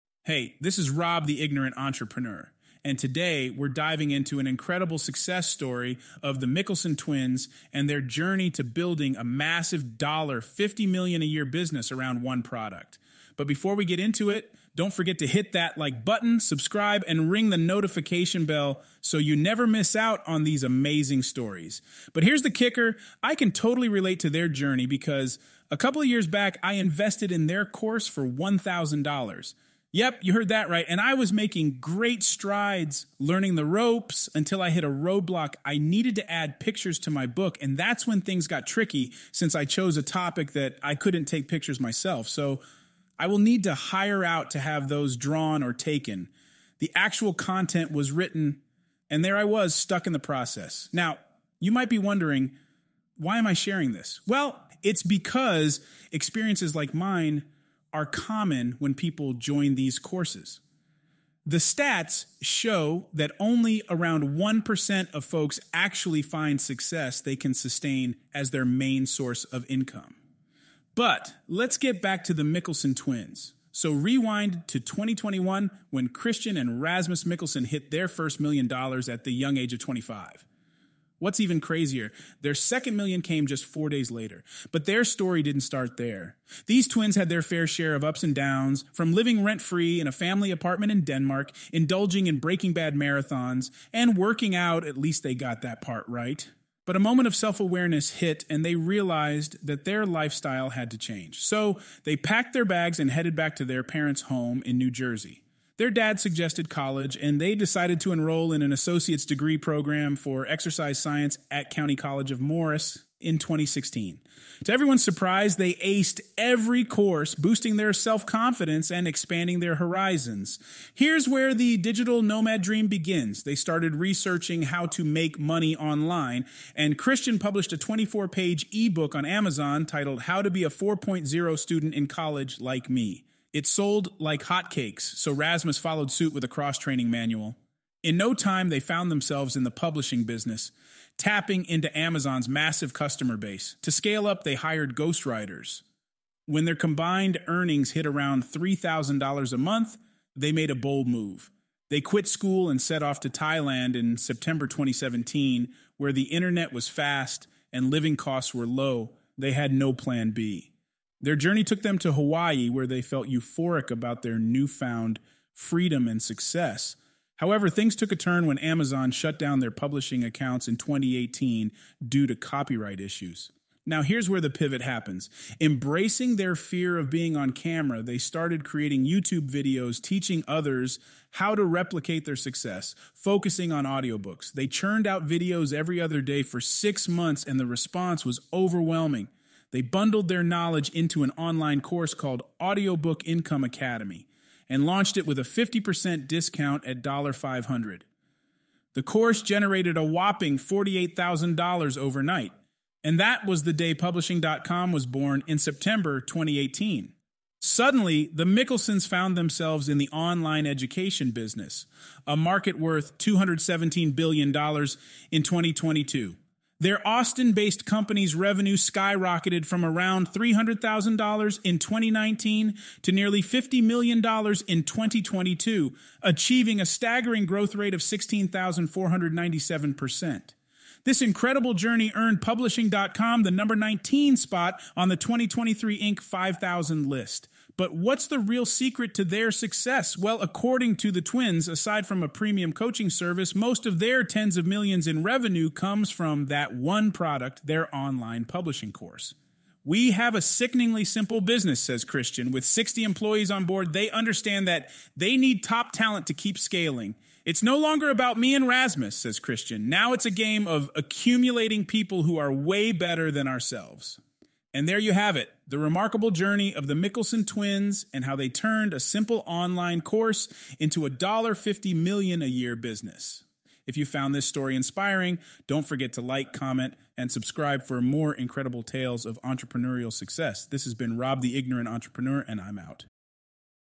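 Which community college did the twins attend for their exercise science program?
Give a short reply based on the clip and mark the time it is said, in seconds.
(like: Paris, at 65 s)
County College of Morris, at 111 s.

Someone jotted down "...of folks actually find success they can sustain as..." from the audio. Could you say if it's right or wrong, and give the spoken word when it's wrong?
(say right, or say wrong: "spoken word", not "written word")
right.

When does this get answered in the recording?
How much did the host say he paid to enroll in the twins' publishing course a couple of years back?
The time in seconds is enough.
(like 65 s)
28 s.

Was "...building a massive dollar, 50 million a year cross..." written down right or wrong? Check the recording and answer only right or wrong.
wrong.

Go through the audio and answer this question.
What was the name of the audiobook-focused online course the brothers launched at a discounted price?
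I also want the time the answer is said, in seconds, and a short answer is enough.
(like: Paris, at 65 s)
Audiobook Income Academy, at 192 s.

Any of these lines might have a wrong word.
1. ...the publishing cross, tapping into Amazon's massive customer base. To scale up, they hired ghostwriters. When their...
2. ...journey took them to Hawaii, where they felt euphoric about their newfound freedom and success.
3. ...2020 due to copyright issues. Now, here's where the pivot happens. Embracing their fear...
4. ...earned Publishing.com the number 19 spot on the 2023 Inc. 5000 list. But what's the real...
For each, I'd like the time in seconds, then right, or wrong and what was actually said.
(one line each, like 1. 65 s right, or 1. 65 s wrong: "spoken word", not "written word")
1. 139 s wrong: "business", not "cross"
2. 161 s right
3. 170 s wrong: "2018", not "2020"
4. 232 s right.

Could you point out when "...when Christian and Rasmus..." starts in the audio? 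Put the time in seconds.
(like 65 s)
75 s.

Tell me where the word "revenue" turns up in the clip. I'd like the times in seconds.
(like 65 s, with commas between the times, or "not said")
218 s, 245 s.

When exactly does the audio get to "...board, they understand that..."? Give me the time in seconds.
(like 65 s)
253 s.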